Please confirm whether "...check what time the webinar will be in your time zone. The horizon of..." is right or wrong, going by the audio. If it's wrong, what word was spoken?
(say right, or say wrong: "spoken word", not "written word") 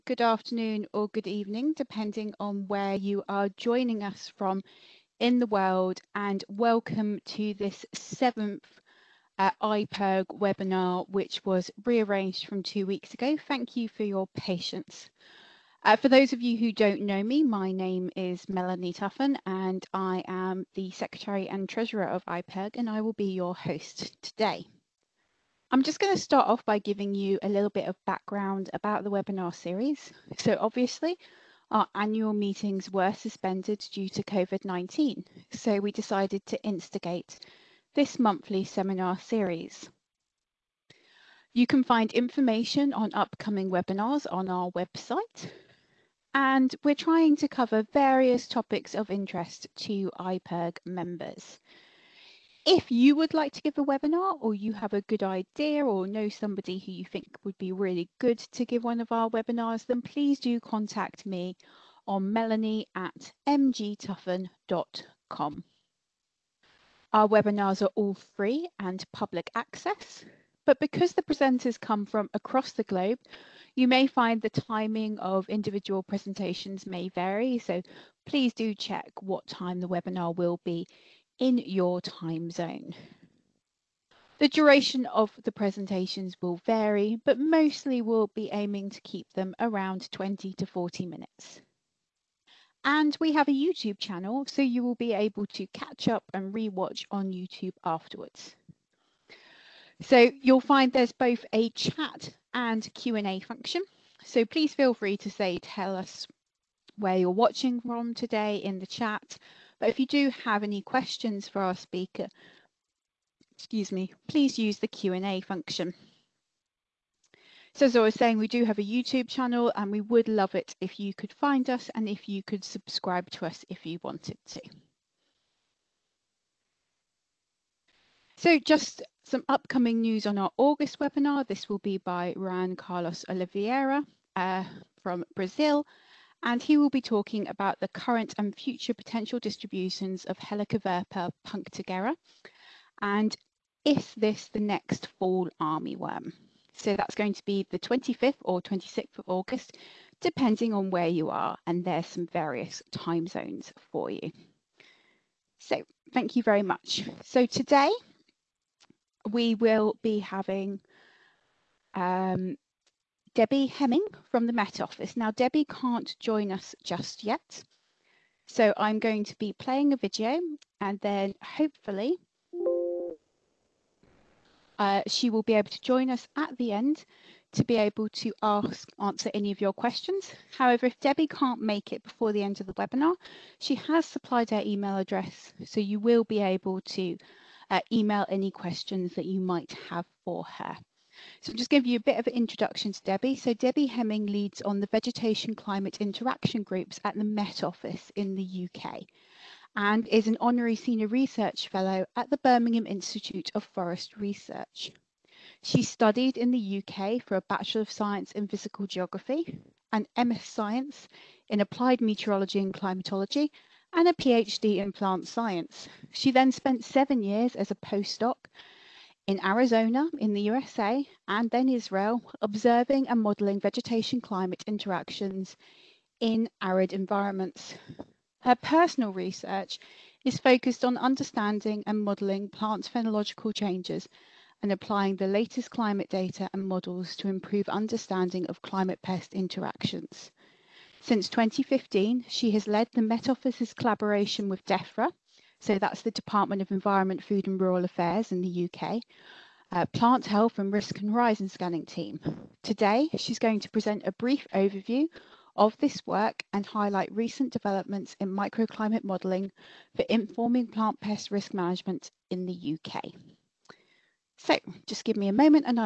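wrong: "duration", not "horizon".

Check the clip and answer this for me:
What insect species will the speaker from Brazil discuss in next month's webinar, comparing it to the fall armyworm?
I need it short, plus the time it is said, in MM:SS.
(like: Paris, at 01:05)
Helicoverpa punctigera, at 02:20.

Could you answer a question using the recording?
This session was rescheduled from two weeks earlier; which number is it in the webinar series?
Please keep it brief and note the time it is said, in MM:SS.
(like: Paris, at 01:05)
Seventh, at 00:07.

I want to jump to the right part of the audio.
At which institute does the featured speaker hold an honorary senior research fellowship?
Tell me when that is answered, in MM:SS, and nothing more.
03:22.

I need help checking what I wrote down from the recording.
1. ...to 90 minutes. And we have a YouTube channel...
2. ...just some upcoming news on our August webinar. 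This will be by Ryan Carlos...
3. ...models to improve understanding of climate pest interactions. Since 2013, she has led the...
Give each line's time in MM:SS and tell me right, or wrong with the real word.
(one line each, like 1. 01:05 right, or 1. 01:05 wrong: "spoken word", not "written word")
1. 01:30 wrong: "40", not "90"
2. 02:08 right
3. 03:56 wrong: "2015", not "2013".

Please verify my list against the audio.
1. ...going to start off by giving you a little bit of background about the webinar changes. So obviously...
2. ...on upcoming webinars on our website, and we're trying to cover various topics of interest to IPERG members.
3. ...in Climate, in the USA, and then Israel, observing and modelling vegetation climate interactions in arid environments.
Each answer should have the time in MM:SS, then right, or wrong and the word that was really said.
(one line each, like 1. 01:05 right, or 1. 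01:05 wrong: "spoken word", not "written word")
1. 00:25 wrong: "series", not "changes"
2. 00:42 right
3. 03:39 wrong: "Arizona", not "Climate".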